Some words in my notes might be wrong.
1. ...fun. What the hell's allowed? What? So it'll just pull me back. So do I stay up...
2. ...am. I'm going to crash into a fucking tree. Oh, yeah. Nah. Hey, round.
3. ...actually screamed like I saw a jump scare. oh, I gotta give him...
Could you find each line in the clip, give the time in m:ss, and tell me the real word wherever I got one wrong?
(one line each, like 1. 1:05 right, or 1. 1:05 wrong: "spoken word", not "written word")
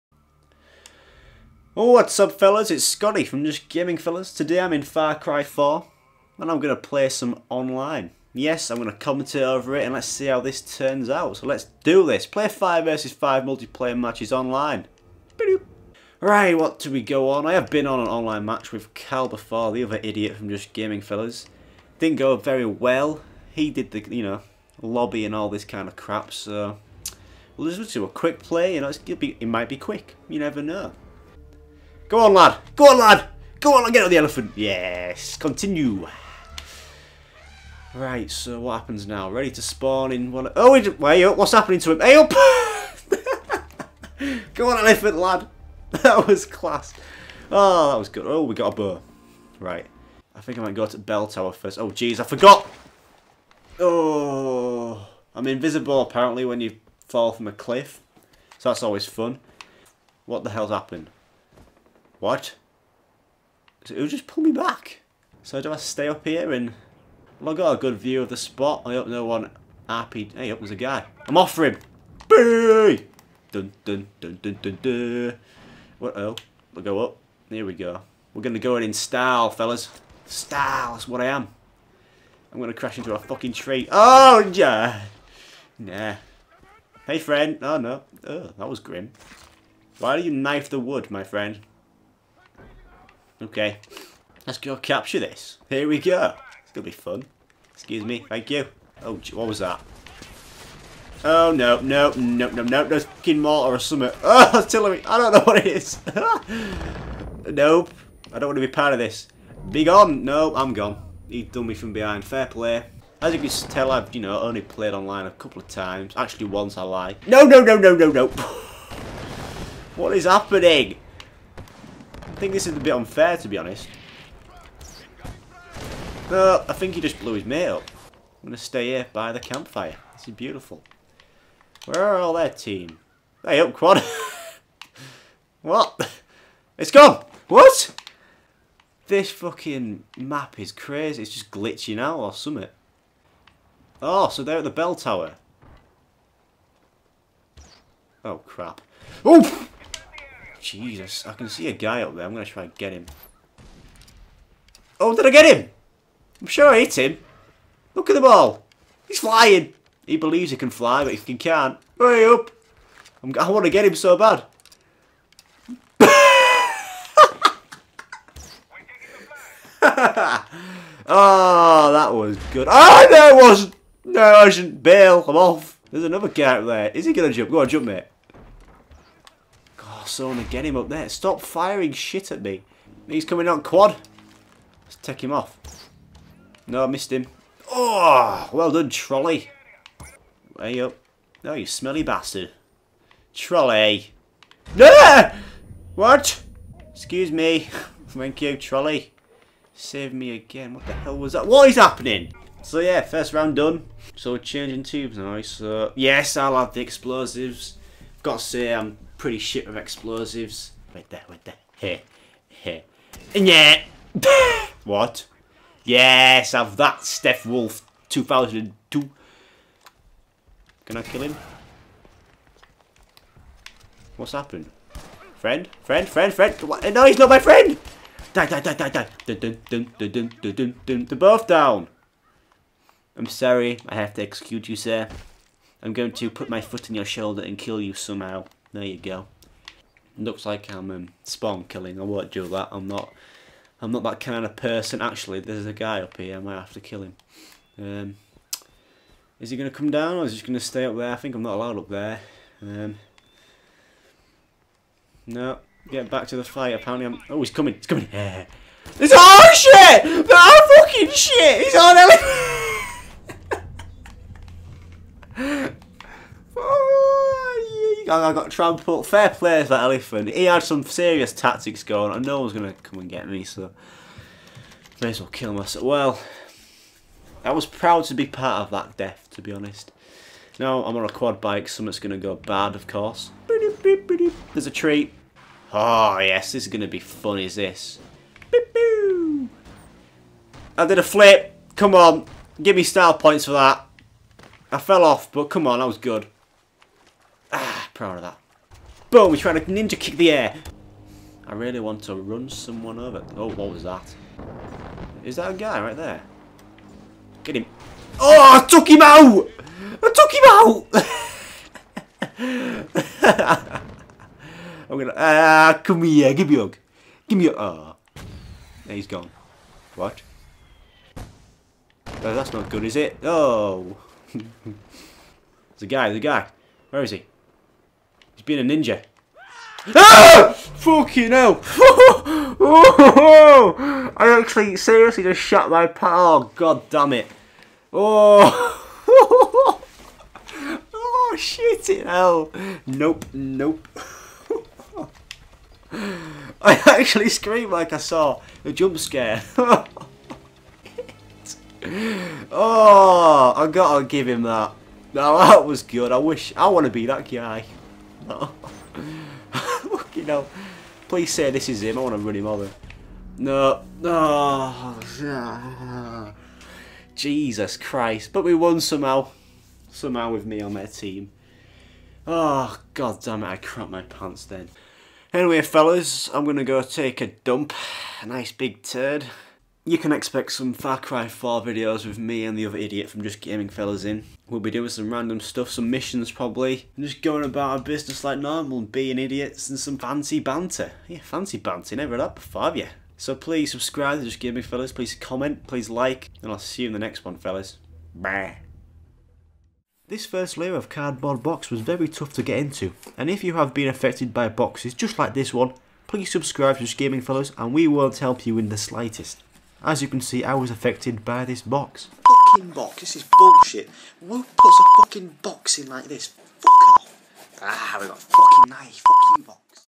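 1. 0:59 wrong: "happened", not "allowed"
2. 1:21 wrong: "friend", not "round"
3. 5:46 right.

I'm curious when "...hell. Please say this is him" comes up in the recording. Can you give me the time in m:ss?
6:00.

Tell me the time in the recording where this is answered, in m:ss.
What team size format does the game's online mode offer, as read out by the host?
0:12.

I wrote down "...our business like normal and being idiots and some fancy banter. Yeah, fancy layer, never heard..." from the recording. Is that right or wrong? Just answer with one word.
wrong.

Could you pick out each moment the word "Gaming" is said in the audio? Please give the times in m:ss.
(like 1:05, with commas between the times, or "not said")
0:03, 0:20, 6:23, 6:34, 6:46.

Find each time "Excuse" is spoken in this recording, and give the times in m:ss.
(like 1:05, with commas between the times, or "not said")
1:37, 3:16.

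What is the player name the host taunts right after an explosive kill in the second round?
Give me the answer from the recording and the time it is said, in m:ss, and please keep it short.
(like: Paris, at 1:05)
Steph Wolf 2002, at 3:37.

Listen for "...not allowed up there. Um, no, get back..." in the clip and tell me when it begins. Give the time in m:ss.
4:11.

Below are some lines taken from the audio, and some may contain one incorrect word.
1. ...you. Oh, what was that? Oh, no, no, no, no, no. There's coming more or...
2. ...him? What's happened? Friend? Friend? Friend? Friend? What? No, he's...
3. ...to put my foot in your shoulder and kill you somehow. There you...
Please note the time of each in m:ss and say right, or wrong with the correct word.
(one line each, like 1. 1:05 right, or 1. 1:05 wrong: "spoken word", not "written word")
1. 1:38 wrong: "fucking", not "coming"
2. 3:41 right
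3. 3:56 right.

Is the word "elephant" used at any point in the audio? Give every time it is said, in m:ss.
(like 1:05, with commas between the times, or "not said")
0:34, 0:44, 4:21, 4:29.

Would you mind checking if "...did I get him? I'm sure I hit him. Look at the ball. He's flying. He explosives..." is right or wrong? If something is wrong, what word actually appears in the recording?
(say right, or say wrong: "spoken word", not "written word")
wrong: "believes", not "explosives".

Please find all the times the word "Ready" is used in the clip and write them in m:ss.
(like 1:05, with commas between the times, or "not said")
0:39.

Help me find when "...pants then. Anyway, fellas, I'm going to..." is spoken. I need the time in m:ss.
6:14.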